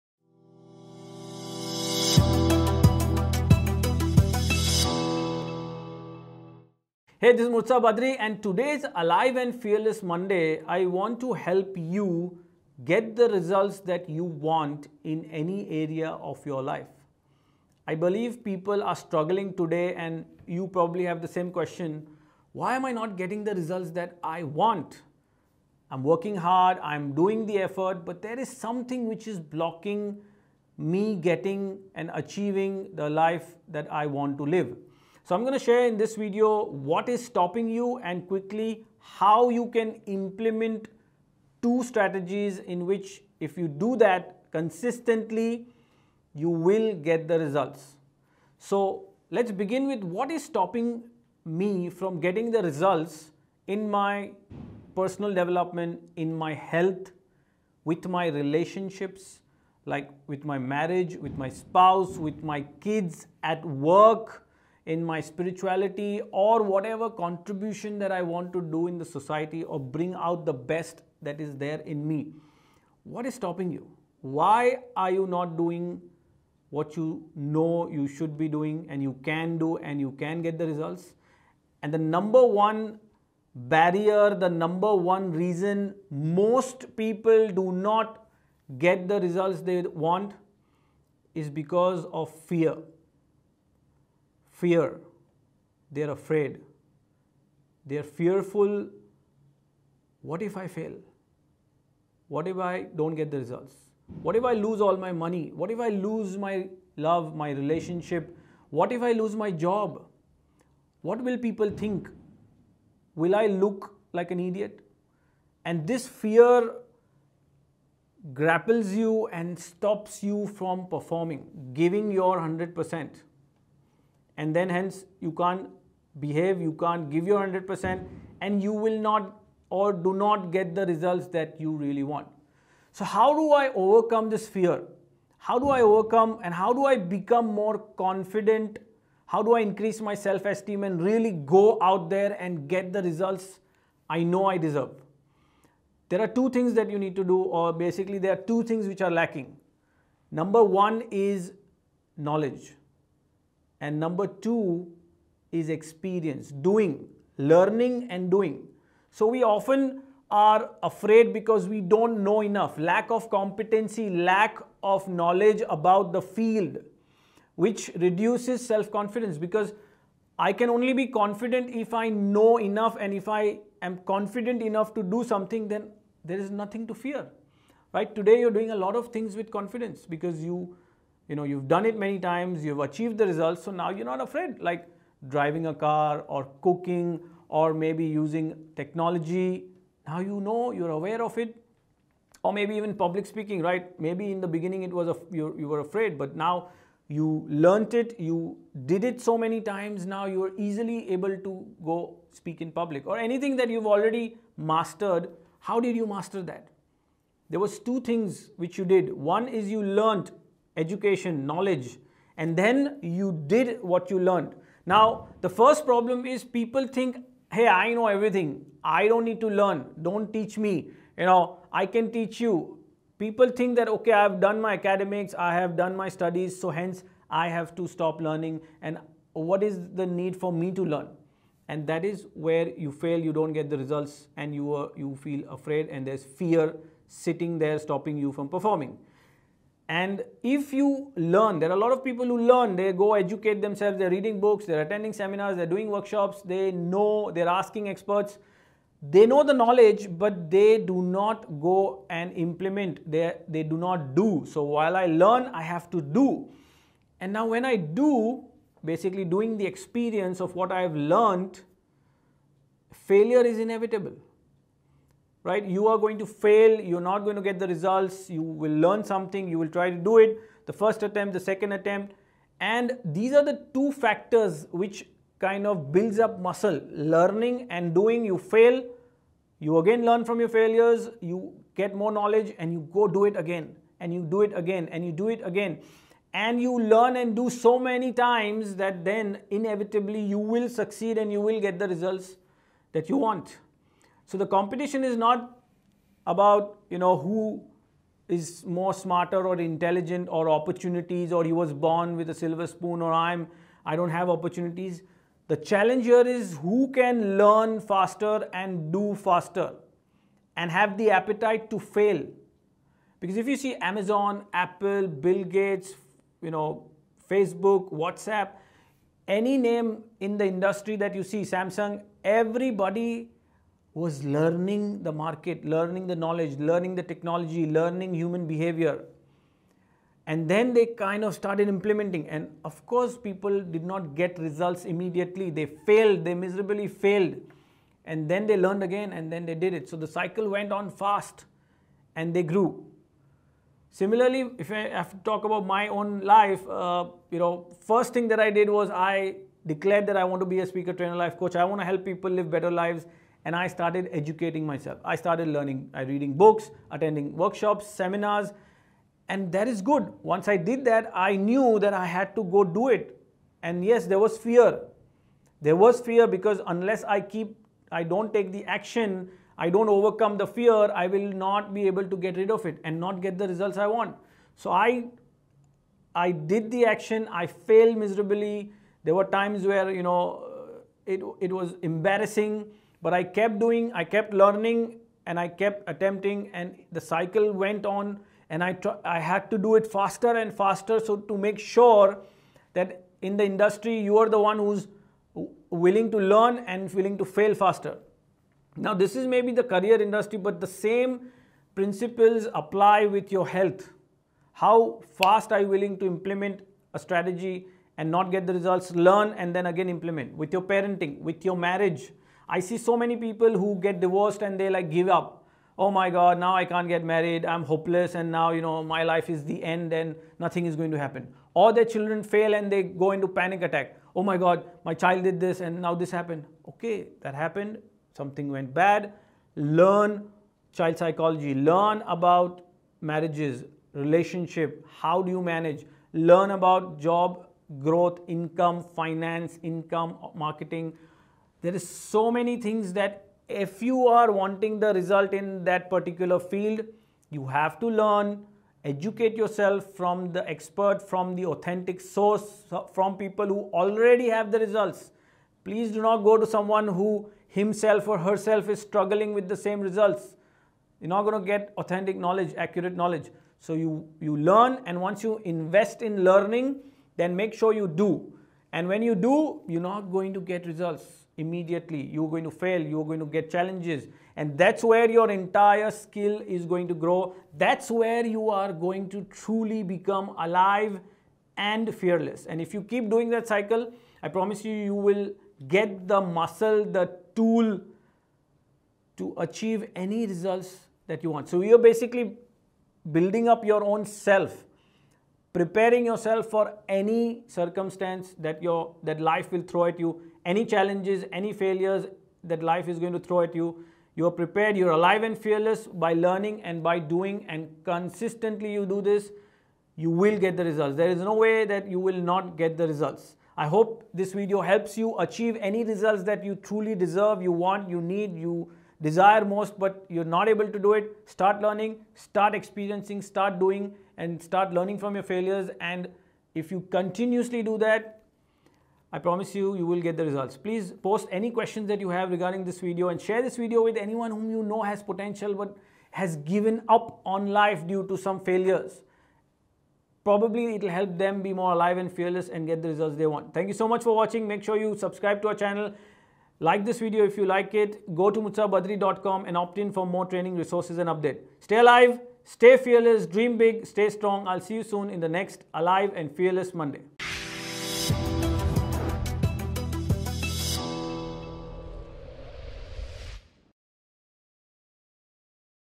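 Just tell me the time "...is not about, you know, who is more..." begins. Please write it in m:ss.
4:55.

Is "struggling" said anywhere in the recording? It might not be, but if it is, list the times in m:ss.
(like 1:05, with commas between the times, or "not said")
0:18, 7:38.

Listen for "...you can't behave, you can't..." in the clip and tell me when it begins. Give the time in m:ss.
2:05.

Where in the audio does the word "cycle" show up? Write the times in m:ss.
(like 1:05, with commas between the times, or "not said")
5:40, 6:27, 8:03.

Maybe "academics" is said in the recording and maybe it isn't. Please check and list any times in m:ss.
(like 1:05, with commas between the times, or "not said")
3:44.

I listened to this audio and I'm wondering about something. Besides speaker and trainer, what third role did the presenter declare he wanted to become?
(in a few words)
life coach.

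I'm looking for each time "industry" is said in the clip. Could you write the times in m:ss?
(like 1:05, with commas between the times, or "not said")
5:20, 6:33, 6:40.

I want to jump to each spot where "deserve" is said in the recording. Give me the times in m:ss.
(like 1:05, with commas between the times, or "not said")
2:24, 8:36.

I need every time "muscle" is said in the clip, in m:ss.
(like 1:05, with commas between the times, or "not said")
4:36, 8:06.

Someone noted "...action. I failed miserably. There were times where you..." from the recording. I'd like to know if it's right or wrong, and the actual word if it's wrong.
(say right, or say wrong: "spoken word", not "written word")
right.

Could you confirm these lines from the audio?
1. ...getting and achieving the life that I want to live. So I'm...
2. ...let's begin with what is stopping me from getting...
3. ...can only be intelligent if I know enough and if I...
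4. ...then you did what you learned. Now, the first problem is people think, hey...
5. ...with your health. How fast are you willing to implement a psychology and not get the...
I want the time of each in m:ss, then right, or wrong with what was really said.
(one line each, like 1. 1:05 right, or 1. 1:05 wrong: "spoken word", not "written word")
1. 0:31 right
2. 0:49 right
3. 2:50 wrong: "confident", not "intelligent"
4. 3:32 right
5. 6:43 wrong: "strategy", not "psychology".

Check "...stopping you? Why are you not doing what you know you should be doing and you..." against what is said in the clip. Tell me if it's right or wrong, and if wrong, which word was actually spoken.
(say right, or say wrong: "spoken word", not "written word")
right.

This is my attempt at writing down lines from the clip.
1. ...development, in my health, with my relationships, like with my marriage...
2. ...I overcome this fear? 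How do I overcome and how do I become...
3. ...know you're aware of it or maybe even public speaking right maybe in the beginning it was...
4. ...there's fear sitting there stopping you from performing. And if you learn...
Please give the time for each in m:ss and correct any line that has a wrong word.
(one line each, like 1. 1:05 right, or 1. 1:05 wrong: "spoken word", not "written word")
1. 0:55 right
2. 2:13 right
3. 3:10 right
4. 3:56 right.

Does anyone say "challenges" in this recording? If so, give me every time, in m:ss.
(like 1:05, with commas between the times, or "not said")
5:05, 7:53, 8:20.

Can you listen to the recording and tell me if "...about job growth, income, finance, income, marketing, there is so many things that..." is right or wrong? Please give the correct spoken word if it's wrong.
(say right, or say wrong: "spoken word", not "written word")
right.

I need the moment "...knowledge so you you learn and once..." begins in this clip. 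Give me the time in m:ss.
7:43.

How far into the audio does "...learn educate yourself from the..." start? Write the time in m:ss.
7:27.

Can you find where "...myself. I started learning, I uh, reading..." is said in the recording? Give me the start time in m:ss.
5:54.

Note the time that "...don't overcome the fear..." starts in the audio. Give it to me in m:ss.
6:09.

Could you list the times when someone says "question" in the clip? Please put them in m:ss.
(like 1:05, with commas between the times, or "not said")
0:21, 8:51.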